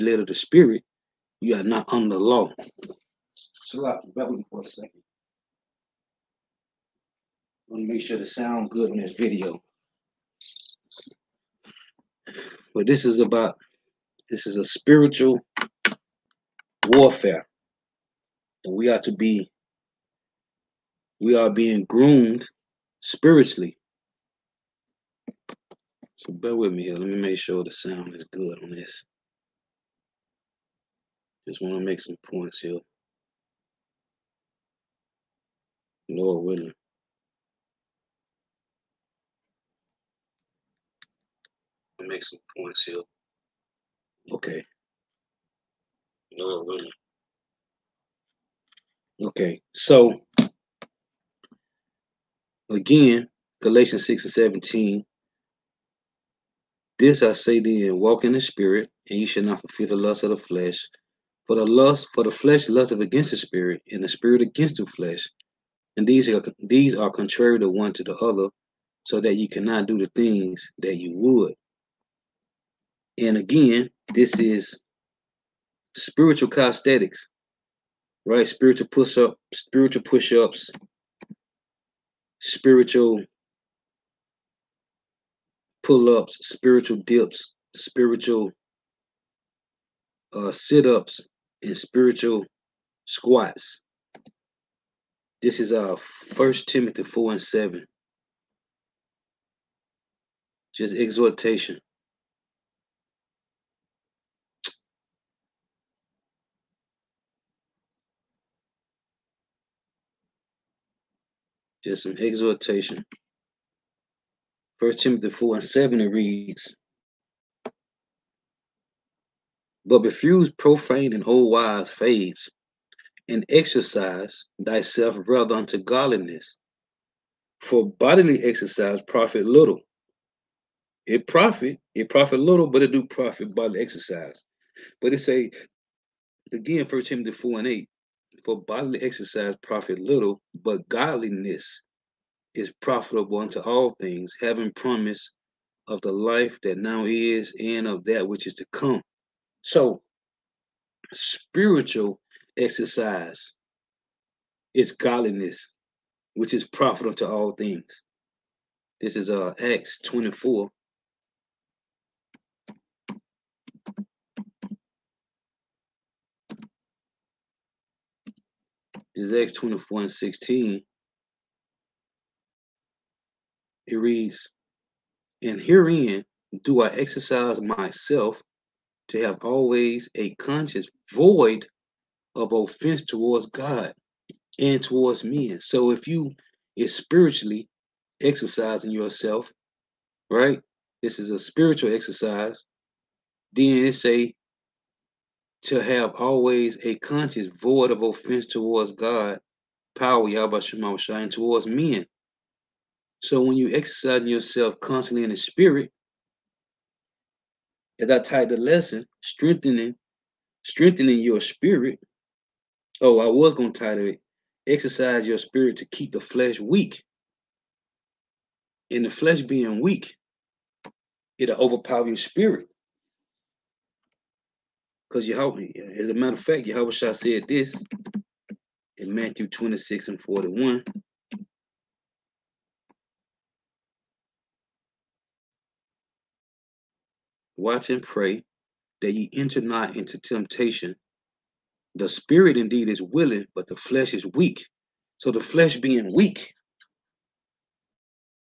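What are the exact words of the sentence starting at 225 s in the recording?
Because you Yahweh, as a matter of fact, Yahweh Shah said this in Matthew 26 and 41.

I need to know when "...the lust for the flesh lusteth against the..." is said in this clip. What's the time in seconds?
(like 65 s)
61 s.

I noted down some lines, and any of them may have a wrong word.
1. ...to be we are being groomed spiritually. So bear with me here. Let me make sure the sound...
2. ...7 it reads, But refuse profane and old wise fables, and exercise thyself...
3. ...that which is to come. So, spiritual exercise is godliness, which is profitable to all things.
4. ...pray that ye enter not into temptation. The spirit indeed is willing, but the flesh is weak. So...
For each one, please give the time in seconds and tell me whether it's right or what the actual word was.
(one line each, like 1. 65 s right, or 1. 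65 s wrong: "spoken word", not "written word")
1. 18 s right
2. 115 s right
3. 148 s right
4. 238 s right.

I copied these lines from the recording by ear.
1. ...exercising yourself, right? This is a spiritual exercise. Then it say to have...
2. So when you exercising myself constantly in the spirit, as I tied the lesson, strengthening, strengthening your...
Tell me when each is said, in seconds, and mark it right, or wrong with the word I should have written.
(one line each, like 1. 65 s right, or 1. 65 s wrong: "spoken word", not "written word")
1. 188 s right
2. 203 s wrong: "yourself", not "myself".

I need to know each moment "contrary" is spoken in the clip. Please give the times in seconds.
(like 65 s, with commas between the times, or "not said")
67 s.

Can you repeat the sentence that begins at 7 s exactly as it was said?
I want to make sure to sound good in this video.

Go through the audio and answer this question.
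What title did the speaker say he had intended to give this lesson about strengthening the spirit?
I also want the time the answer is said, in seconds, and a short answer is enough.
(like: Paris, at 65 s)
Exercise your spirit to keep the flesh weak, at 214 s.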